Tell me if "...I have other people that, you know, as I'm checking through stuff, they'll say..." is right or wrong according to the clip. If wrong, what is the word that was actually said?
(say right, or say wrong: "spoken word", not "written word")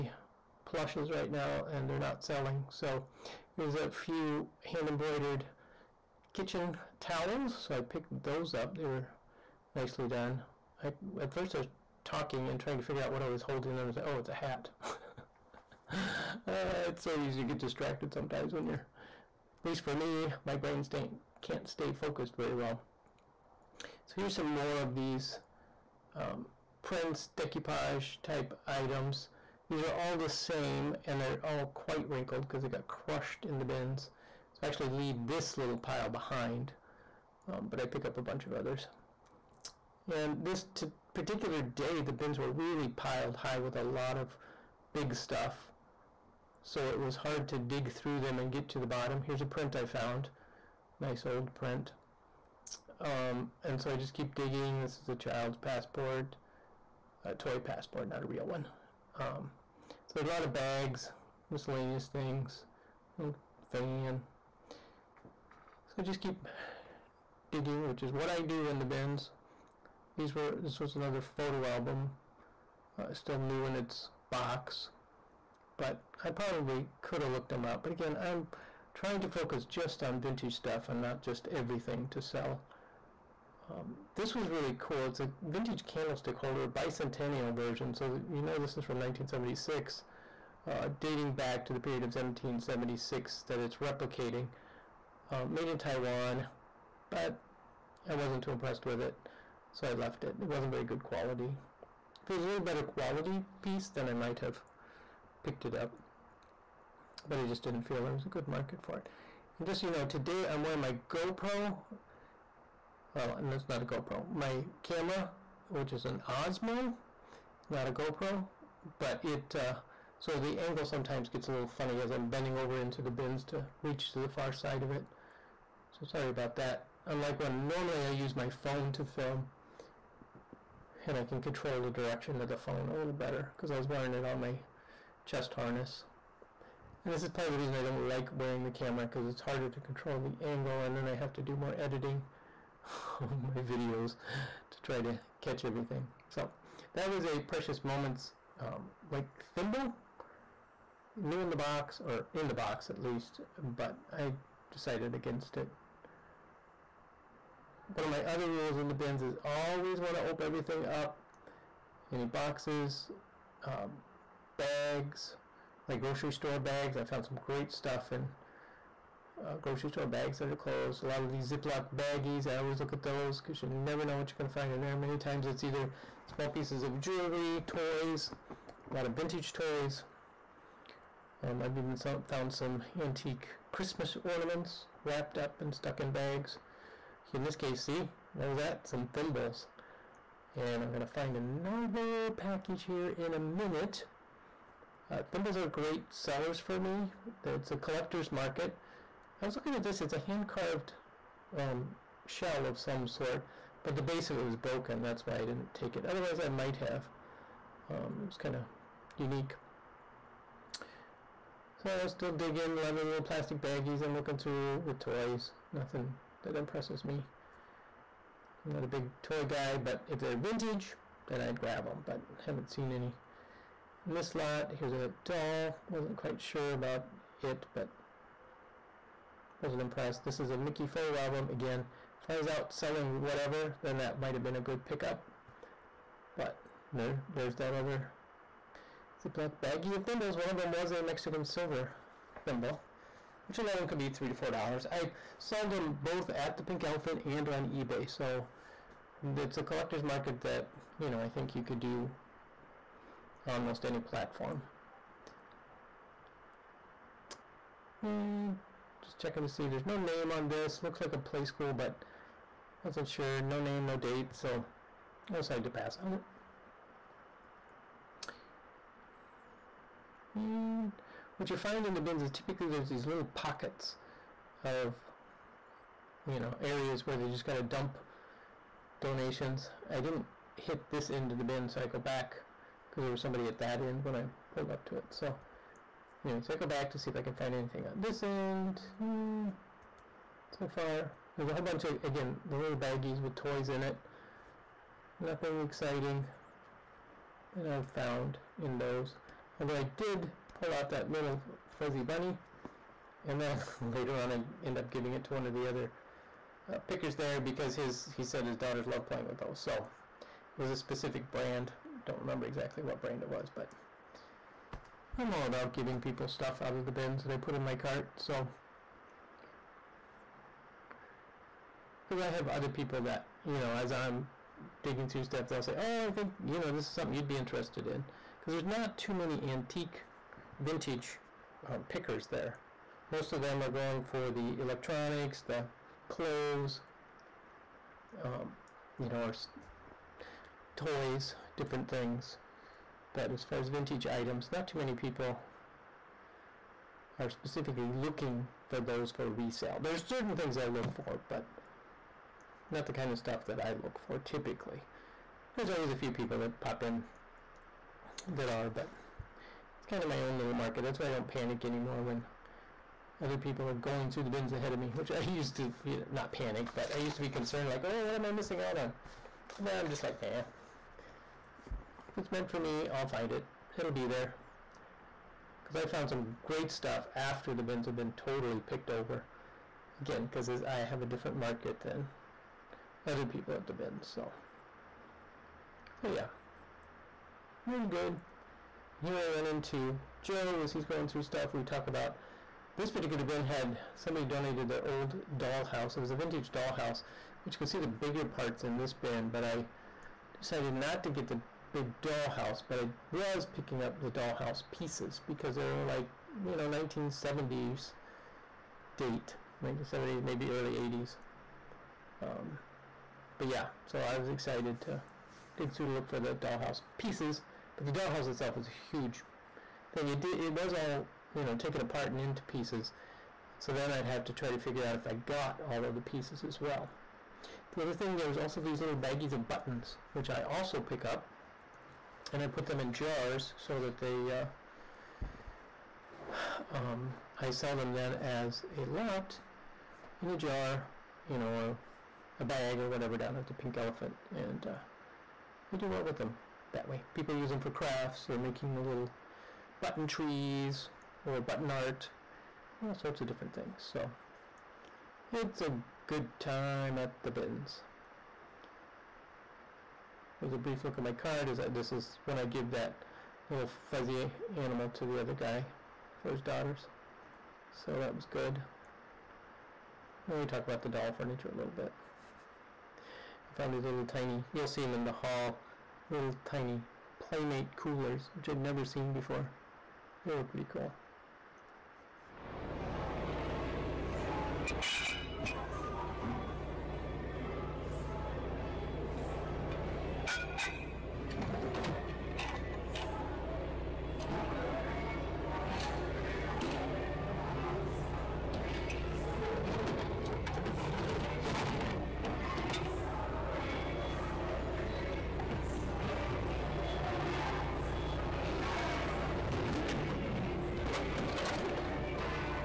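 wrong: "digging", not "checking".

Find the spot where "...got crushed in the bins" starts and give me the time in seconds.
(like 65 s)
32 s.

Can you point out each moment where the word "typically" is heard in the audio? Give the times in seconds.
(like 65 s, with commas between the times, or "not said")
272 s, 354 s.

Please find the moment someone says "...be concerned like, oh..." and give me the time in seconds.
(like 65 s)
367 s.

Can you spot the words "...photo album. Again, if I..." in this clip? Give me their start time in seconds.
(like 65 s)
230 s.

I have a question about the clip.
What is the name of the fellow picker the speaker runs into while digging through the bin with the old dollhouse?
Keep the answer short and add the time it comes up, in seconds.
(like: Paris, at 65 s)
Joe, at 390 s.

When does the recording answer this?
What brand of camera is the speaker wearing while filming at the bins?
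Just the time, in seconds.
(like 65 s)
116 s.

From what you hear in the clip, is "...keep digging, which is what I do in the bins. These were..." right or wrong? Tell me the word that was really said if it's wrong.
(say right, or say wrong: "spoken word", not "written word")
right.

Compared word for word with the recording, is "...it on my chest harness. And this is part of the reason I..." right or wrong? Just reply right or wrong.
right.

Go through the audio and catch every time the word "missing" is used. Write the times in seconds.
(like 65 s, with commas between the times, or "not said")
368 s.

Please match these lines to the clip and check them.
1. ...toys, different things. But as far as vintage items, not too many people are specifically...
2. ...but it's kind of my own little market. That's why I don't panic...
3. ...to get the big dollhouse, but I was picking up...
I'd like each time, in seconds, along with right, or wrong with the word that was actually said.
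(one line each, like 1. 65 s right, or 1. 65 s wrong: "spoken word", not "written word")
1. 340 s right
2. 358 s right
3. 401 s right.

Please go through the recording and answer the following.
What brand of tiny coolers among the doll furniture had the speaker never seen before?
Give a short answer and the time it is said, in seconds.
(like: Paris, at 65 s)
Playmate, at 477 s.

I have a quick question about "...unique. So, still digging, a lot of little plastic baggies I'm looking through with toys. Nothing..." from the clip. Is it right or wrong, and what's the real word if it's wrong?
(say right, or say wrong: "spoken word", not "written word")
right.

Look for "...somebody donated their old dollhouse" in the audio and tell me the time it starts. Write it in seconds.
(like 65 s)
393 s.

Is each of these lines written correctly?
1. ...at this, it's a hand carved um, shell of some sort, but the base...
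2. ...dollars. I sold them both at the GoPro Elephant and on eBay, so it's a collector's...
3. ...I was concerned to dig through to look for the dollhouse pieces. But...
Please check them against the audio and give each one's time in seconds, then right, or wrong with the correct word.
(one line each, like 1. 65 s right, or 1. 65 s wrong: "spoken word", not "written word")
1. 199 s right
2. 244 s wrong: "Pink", not "GoPro"
3. 414 s wrong: "excited", not "concerned".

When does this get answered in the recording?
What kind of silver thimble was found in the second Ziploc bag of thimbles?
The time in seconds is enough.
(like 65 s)
241 s.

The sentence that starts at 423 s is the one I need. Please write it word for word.
So then I'd have to try to figure out if I got all of the pieces as well.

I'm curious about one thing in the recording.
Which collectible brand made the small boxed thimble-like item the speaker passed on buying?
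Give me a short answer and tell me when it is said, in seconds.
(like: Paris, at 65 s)
Precious Moments, at 147 s.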